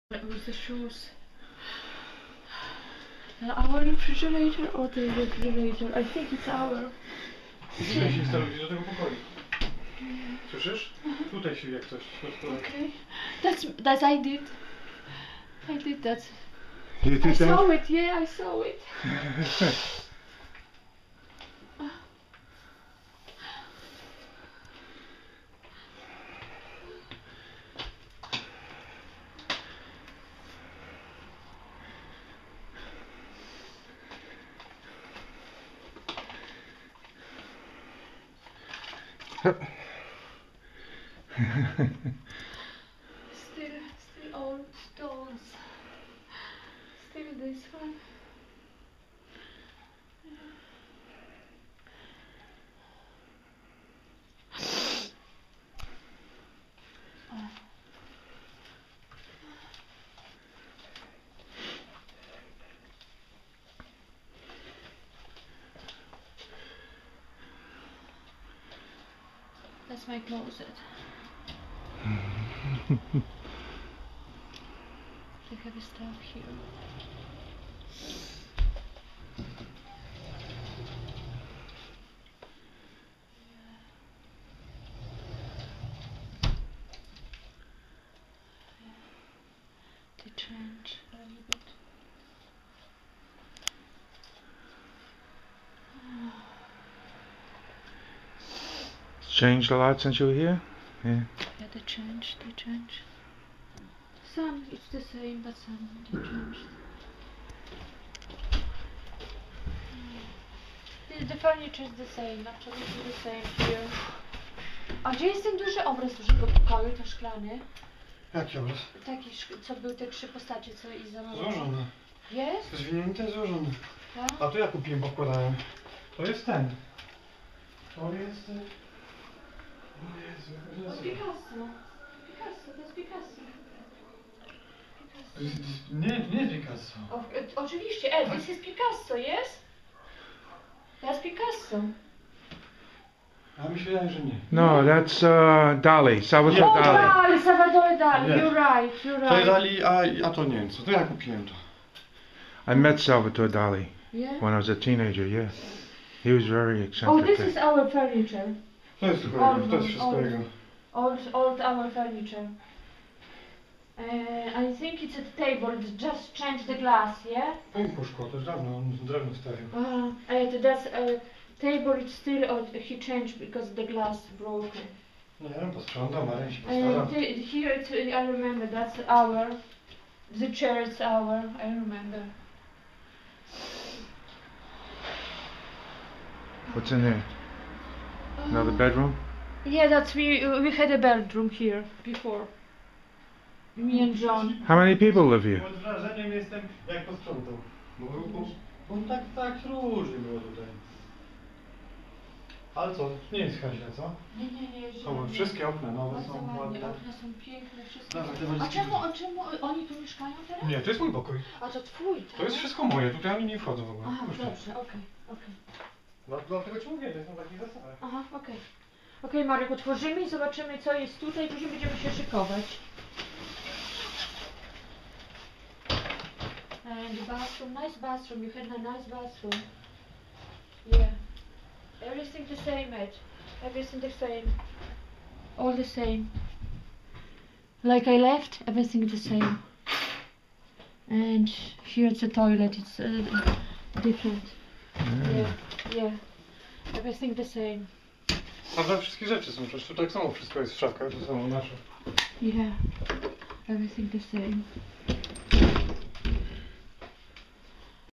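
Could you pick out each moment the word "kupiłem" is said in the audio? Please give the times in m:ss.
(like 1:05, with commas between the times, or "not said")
2:04, 2:31.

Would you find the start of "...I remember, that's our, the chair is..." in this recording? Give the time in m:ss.
2:57.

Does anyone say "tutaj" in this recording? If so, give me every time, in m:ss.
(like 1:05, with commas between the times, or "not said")
0:07, 3:33, 3:41.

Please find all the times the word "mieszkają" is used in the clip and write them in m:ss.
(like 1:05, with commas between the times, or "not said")
3:30.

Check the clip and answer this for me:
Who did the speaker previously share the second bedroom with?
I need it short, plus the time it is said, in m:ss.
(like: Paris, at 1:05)
John, at 3:14.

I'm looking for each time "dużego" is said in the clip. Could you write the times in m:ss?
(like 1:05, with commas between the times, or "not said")
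1:56.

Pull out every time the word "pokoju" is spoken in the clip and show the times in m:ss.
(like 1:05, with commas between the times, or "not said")
0:08, 1:56.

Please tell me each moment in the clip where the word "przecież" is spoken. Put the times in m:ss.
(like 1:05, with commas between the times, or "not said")
4:09.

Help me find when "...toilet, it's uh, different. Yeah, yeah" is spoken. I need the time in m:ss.
4:02.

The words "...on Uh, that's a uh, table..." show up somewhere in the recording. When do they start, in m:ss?
2:48.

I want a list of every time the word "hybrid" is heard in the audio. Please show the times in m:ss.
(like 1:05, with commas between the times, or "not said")
not said.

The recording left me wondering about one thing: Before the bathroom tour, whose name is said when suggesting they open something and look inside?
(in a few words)
Marek.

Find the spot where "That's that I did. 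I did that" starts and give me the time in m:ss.
0:13.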